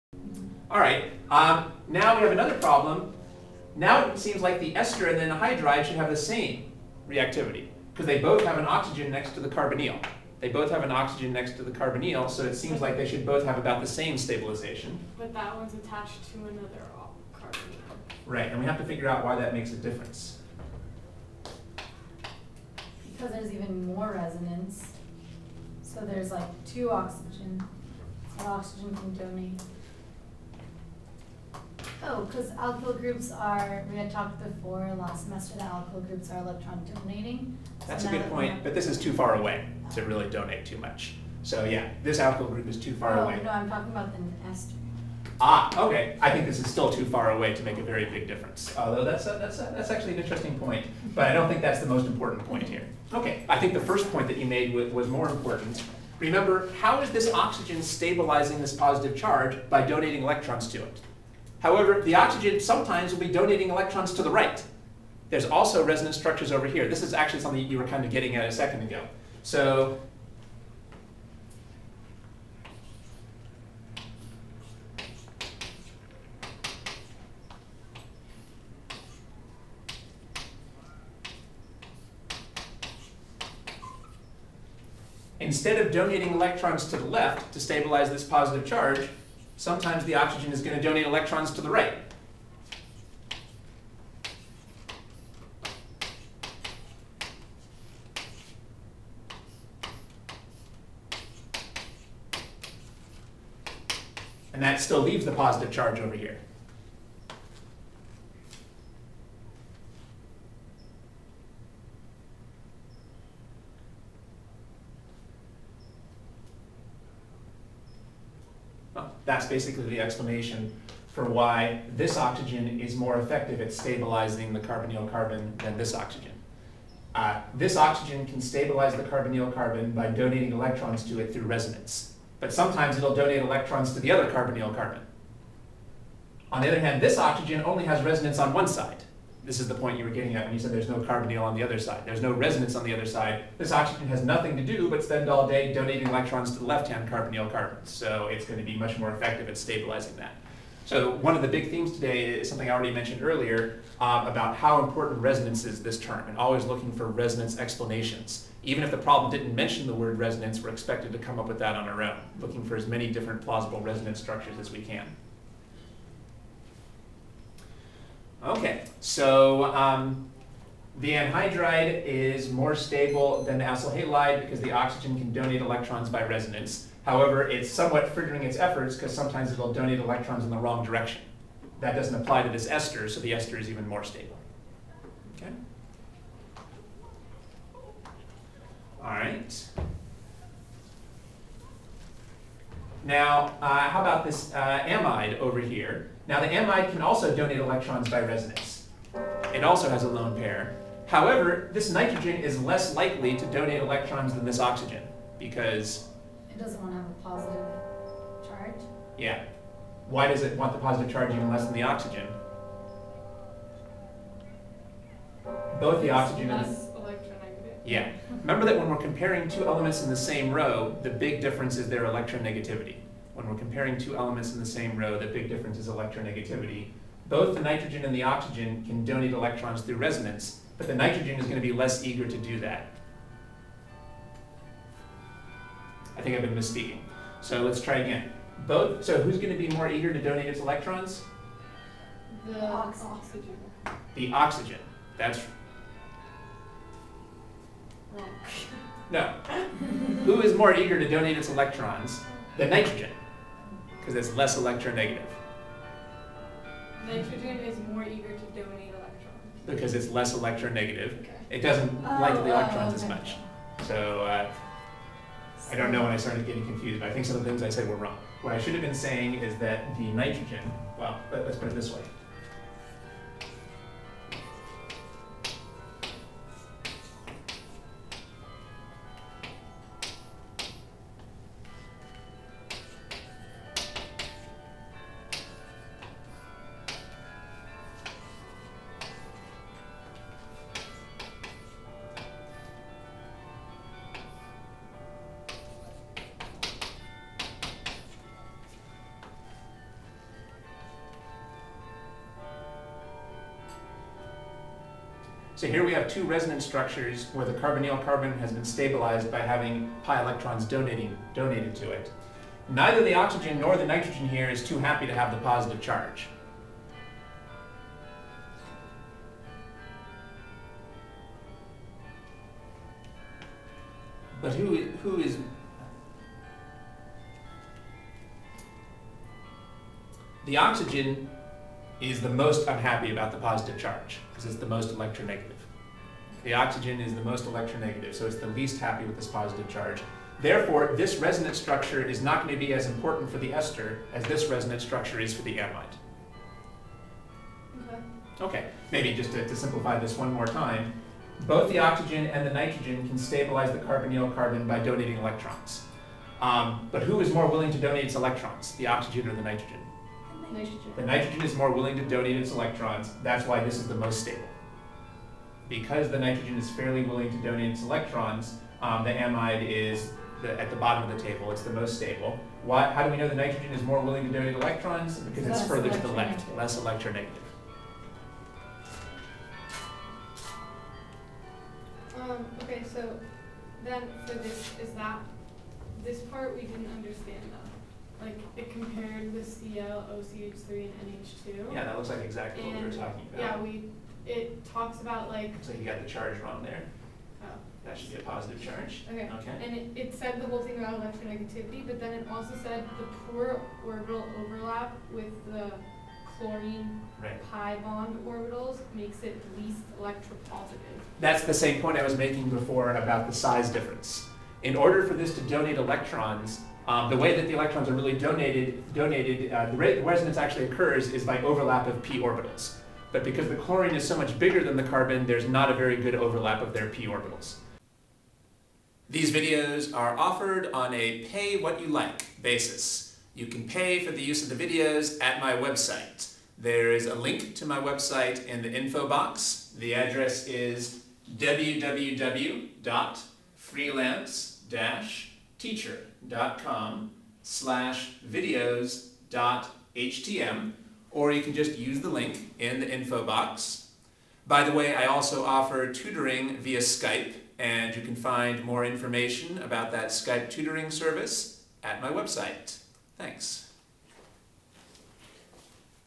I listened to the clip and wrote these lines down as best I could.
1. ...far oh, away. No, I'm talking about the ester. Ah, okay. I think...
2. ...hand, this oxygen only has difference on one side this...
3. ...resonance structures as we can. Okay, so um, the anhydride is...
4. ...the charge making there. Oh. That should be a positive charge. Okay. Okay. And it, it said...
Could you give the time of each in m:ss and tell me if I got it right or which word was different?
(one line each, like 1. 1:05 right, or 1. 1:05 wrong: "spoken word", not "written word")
1. 0:42 right
2. 2:16 wrong: "resonance", not "difference"
3. 2:43 right
4. 6:36 wrong: "wrong", not "making".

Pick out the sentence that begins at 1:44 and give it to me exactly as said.
And that still leaves the positive charge over here.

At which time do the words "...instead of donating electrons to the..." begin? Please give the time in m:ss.
1:25.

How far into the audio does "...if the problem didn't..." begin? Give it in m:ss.
2:38.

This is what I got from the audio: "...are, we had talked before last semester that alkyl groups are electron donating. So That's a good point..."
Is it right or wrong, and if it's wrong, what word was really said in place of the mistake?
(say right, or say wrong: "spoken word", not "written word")
right.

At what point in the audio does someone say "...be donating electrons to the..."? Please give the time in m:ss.
1:03.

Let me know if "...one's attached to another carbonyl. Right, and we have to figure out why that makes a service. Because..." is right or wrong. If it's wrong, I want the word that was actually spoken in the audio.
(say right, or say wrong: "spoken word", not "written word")
wrong: "difference", not "service".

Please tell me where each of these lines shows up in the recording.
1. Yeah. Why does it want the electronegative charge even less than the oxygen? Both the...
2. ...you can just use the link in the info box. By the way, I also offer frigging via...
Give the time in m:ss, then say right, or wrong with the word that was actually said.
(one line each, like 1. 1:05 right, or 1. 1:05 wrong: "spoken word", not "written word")
1. 3:29 wrong: "positive", not "electronegative"
2. 7:31 wrong: "tutoring", not "frigging".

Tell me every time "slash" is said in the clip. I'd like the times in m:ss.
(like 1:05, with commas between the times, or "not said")
7:27.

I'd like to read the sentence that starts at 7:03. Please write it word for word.
But because the chlorine is so much bigger than the carbon, there's not a very good overlap of their p orbitals.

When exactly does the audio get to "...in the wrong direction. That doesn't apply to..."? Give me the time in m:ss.
3:00.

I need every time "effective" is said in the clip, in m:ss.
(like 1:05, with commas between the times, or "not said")
2:03, 2:29.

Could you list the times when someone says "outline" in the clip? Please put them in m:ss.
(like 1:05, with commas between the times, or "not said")
not said.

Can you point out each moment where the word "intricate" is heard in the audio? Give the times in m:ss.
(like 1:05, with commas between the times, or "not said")
not said.